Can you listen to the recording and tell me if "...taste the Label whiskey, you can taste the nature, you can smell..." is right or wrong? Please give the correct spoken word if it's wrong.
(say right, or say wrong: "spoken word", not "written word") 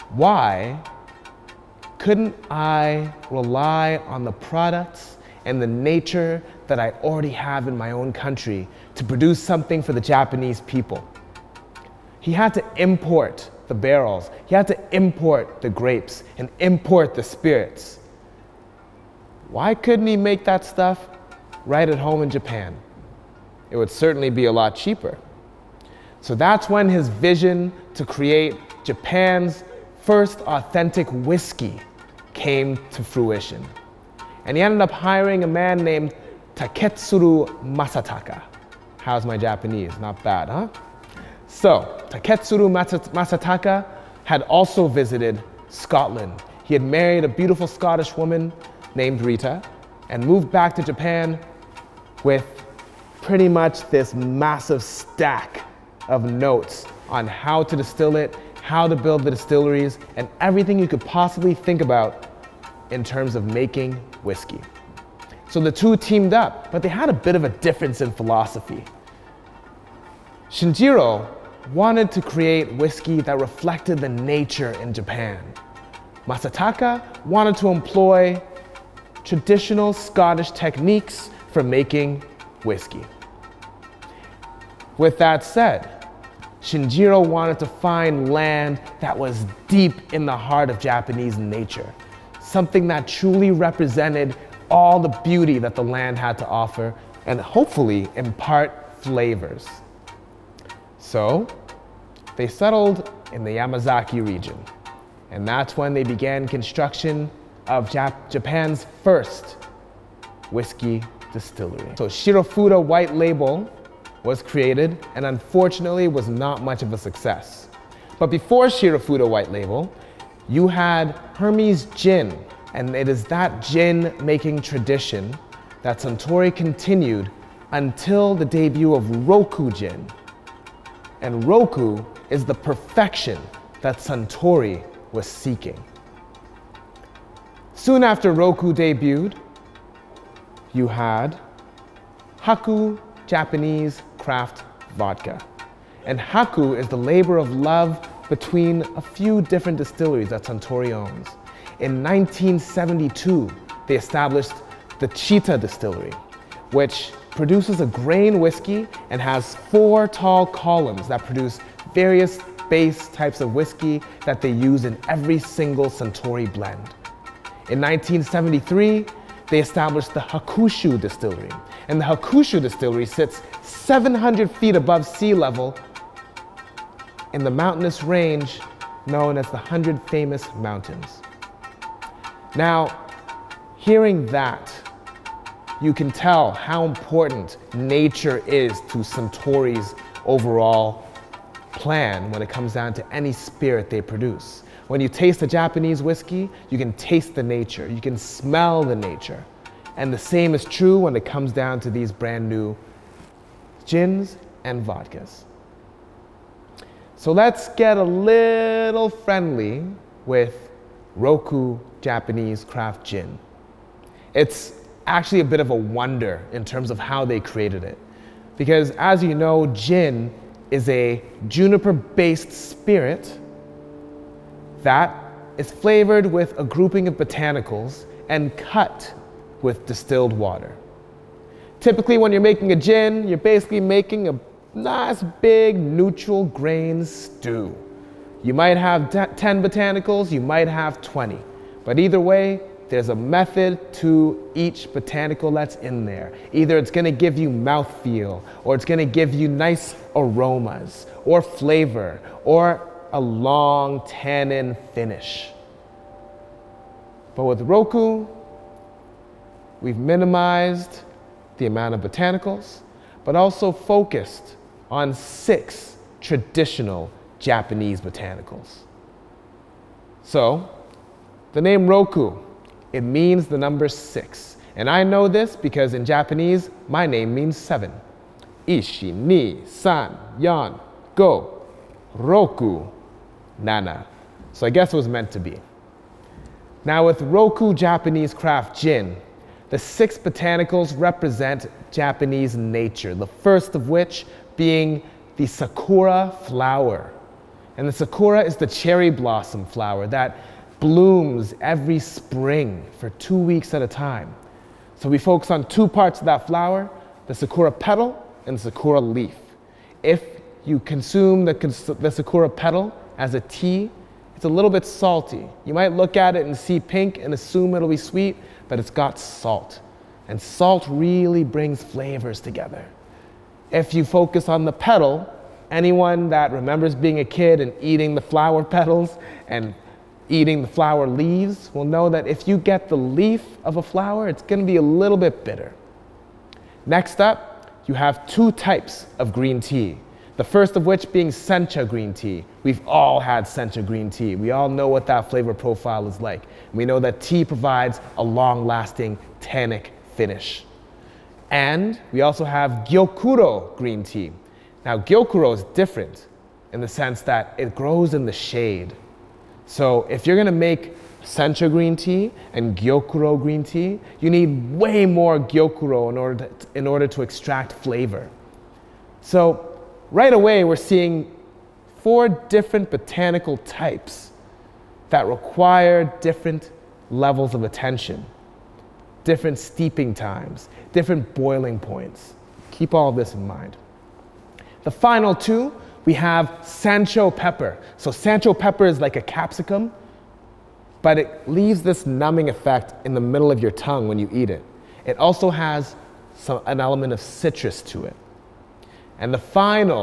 wrong: "Japanese", not "Label".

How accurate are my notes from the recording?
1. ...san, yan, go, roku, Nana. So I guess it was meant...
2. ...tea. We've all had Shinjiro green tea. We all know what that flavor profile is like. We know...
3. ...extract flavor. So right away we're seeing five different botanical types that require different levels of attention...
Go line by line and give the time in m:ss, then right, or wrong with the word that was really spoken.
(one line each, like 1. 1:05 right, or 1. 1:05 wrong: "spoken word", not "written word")
1. 4:39 right
2. 5:42 wrong: "Sencha", not "Shinjiro"
3. 6:07 wrong: "four", not "five".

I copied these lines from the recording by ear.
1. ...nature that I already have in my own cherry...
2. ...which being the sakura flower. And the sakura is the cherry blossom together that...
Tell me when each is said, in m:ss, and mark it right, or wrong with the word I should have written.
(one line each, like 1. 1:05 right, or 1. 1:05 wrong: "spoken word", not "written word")
1. 0:05 wrong: "country", not "cherry"
2. 4:53 wrong: "flower", not "together".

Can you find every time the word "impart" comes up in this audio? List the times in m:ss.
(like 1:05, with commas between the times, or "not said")
1:38.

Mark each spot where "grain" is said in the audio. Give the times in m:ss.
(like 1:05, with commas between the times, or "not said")
2:37, 3:56.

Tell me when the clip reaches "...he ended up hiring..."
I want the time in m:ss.
0:34.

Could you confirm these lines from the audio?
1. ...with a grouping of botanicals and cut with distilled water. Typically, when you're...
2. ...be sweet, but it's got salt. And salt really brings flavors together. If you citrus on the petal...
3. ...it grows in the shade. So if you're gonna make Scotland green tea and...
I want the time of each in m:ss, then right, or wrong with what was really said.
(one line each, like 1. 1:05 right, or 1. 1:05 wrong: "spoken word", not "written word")
1. 3:46 right
2. 5:17 wrong: "focus", not "citrus"
3. 5:57 wrong: "Sencha", not "Scotland".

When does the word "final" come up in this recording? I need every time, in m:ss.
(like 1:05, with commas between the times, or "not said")
6:24, 6:39.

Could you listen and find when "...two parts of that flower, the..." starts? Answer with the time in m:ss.
5:05.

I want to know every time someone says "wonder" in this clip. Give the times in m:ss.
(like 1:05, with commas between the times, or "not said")
3:35.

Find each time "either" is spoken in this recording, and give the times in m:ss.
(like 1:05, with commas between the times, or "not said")
4:01, 4:06.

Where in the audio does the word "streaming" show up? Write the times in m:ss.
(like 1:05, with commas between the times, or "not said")
not said.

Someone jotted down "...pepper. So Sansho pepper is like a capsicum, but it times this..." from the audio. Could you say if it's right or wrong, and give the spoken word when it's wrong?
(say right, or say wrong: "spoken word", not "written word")
wrong: "leaves", not "times".